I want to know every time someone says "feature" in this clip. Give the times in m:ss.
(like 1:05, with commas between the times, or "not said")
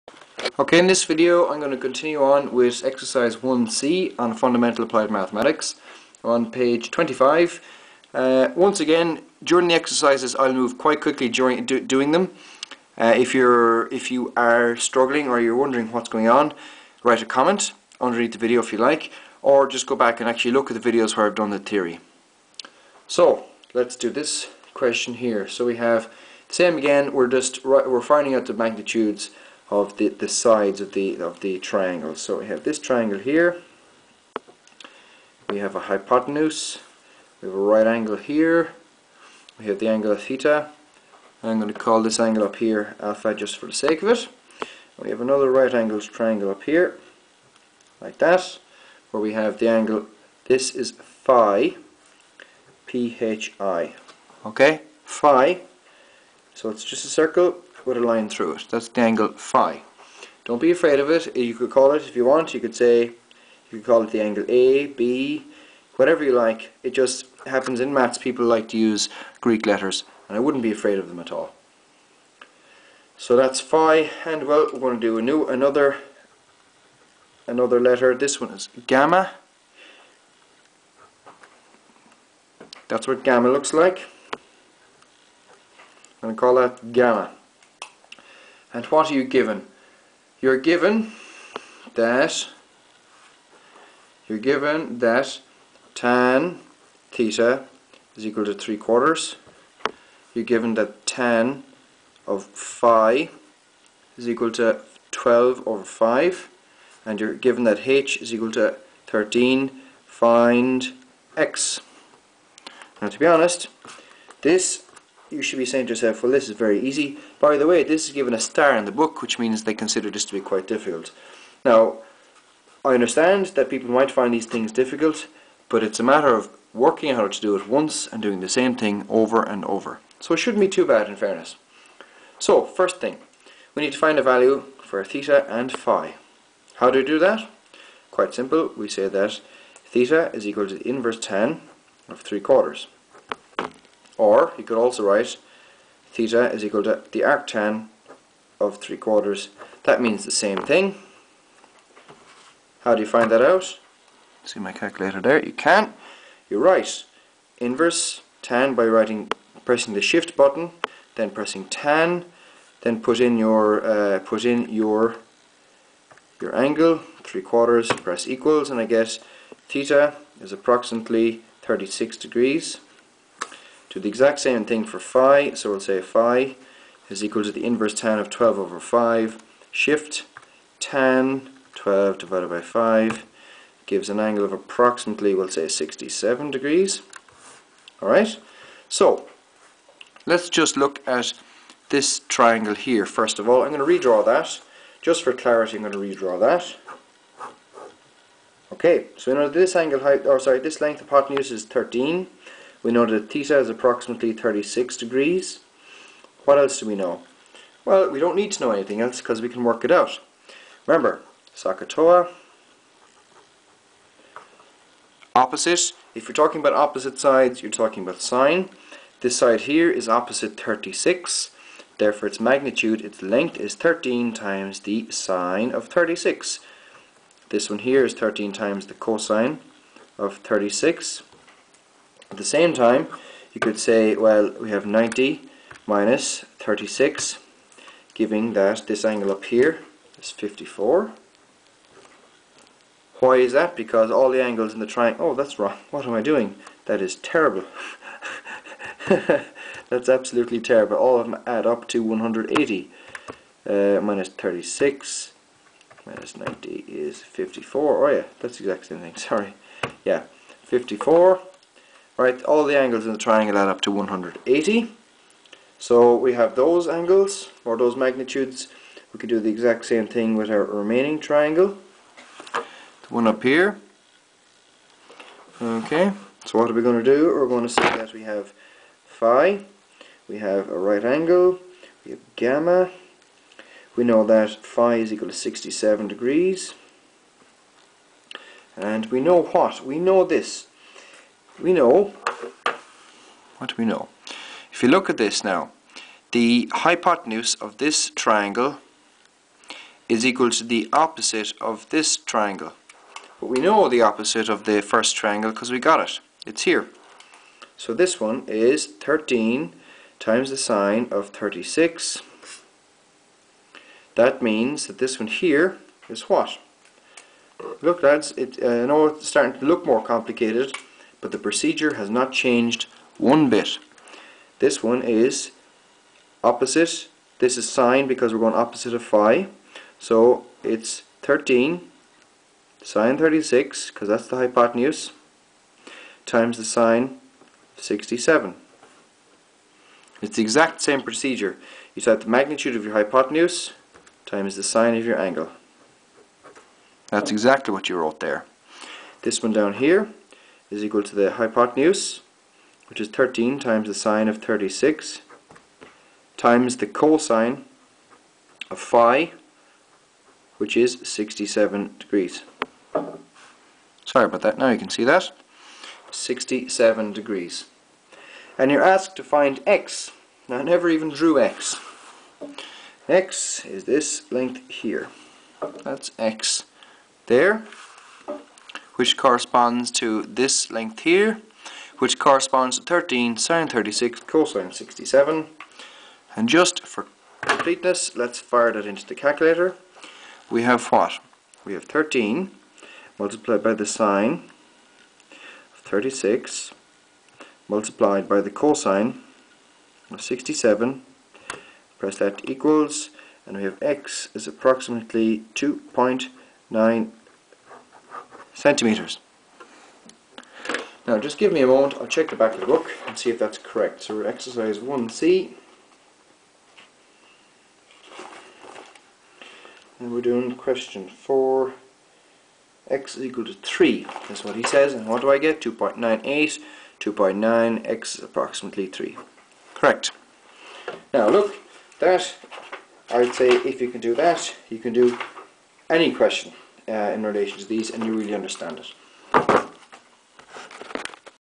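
not said.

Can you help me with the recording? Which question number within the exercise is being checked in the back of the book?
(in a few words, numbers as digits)
4.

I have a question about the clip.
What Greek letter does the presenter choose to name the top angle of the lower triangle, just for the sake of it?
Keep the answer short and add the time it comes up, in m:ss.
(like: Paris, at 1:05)
alpha, at 0:42.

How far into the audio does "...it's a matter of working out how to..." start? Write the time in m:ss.
2:05.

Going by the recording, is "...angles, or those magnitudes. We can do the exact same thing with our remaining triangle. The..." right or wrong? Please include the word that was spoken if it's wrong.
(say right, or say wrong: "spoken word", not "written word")
right.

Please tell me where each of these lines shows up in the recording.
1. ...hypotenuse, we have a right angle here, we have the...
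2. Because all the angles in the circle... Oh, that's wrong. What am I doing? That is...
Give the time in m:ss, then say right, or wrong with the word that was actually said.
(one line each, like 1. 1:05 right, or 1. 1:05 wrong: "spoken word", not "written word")
1. 0:35 right
2. 4:03 wrong: "triangle", not "circle".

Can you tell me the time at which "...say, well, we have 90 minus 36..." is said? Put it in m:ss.
3:53.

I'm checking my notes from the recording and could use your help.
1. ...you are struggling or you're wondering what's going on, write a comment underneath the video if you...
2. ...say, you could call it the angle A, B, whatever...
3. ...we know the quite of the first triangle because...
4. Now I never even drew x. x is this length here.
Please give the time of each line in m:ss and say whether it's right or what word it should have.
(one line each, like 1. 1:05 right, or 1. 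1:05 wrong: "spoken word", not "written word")
1. 0:14 right
2. 1:02 right
3. 5:03 wrong: "opposite", not "quite"
4. 6:10 right.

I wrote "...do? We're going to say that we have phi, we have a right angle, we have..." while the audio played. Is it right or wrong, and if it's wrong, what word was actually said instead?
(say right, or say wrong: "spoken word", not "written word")
right.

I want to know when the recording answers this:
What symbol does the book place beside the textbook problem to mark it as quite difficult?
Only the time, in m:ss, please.
1:58.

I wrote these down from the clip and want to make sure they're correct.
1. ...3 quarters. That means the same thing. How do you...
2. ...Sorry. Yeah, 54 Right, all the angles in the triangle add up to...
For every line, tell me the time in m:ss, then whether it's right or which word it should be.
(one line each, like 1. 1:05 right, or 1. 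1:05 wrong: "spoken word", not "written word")
1. 2:28 right
2. 4:19 right.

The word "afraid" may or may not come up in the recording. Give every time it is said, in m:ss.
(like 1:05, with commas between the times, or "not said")
1:00, 1:10.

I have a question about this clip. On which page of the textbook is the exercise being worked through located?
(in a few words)
25.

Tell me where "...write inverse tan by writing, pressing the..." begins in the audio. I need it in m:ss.
2:36.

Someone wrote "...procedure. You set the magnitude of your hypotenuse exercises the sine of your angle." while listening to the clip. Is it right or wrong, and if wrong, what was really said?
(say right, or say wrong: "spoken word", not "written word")
wrong: "times", not "exercises".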